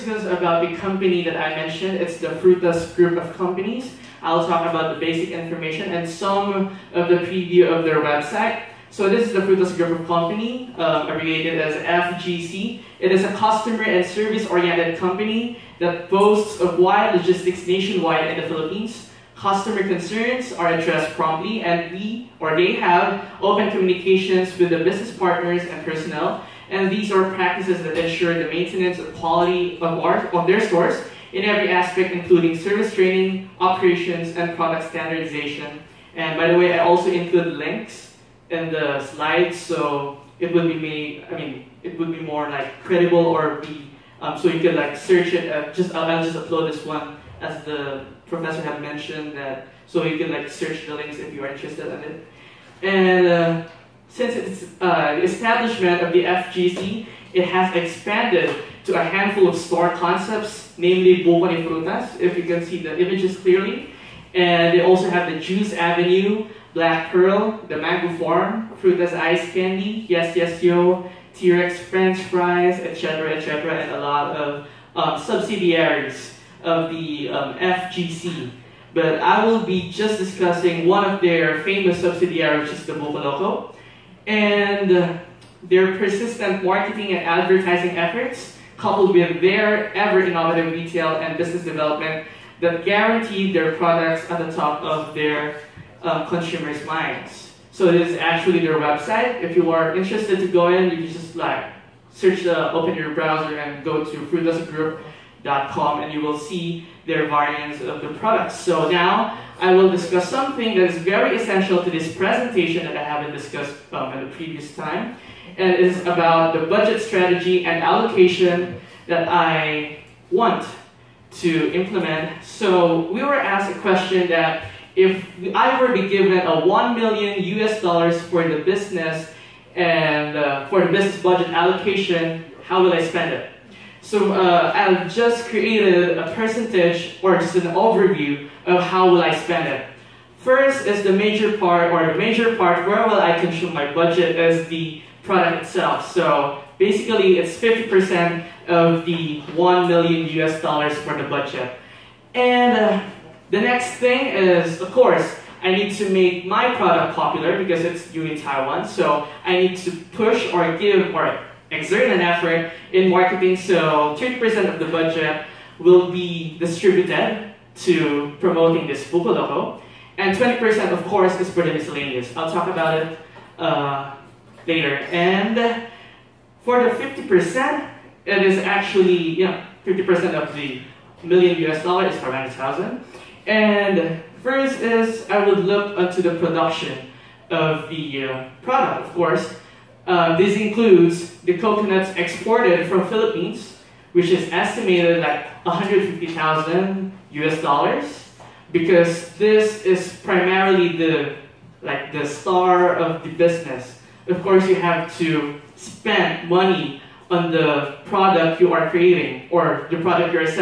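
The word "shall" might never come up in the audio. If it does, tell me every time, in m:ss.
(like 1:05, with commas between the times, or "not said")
not said.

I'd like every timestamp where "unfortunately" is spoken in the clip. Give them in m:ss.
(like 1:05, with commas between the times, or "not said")
not said.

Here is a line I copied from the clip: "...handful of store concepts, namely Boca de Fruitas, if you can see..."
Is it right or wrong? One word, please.
right.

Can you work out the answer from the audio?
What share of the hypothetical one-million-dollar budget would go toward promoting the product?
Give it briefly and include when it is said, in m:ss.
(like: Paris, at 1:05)
30%, at 2:44.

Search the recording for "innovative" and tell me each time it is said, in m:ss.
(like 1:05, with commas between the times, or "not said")
1:29.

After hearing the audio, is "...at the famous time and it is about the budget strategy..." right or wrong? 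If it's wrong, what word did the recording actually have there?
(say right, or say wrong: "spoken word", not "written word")
wrong: "previous", not "famous".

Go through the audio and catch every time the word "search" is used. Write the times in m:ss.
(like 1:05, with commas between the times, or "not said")
0:44, 0:50, 1:42.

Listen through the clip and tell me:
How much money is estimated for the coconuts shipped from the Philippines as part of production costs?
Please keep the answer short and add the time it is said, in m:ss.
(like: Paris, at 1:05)
150,000 US dollars, at 3:15.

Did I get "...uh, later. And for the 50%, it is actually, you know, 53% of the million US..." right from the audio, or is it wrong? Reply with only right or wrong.
wrong.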